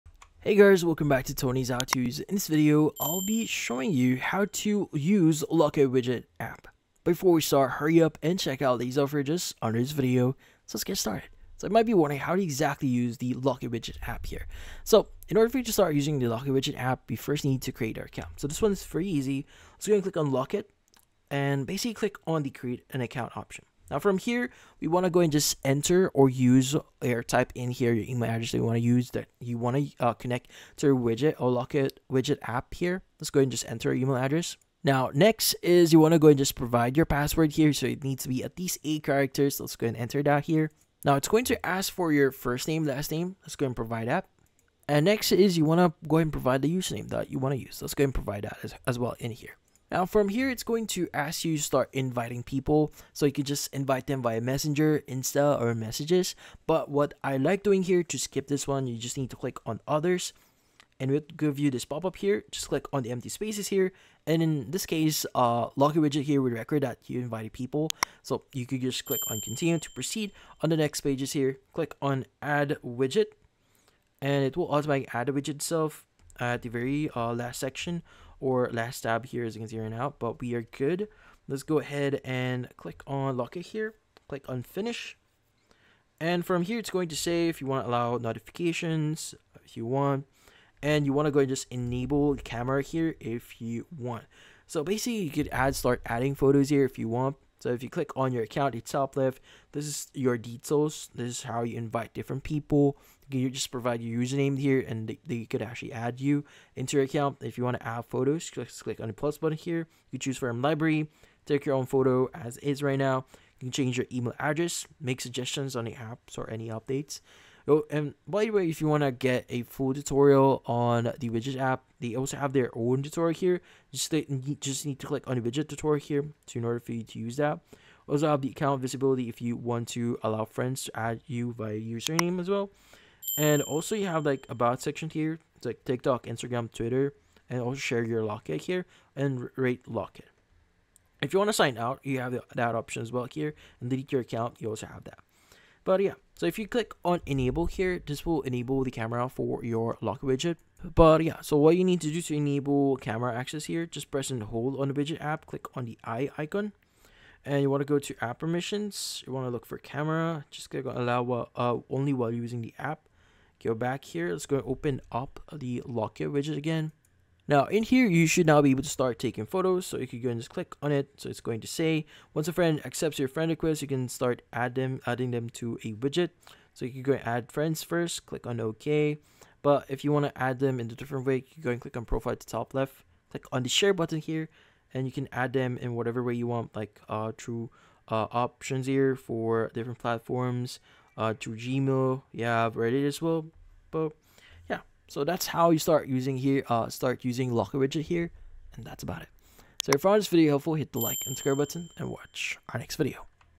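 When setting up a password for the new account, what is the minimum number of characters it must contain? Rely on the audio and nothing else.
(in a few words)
8.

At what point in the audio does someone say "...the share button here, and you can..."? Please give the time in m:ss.
3:03.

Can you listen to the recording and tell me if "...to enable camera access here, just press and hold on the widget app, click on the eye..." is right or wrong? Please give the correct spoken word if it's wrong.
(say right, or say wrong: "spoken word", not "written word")
right.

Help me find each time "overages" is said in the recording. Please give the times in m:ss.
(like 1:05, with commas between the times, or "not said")
0:08.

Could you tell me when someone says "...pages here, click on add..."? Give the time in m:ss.
1:11.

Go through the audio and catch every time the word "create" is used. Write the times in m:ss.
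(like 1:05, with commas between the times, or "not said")
0:17, 0:22.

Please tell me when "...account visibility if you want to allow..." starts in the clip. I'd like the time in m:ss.
2:08.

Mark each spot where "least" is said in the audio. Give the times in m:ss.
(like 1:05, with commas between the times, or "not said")
0:38.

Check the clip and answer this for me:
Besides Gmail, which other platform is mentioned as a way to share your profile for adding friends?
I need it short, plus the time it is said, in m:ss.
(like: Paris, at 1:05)
Reddit, at 3:12.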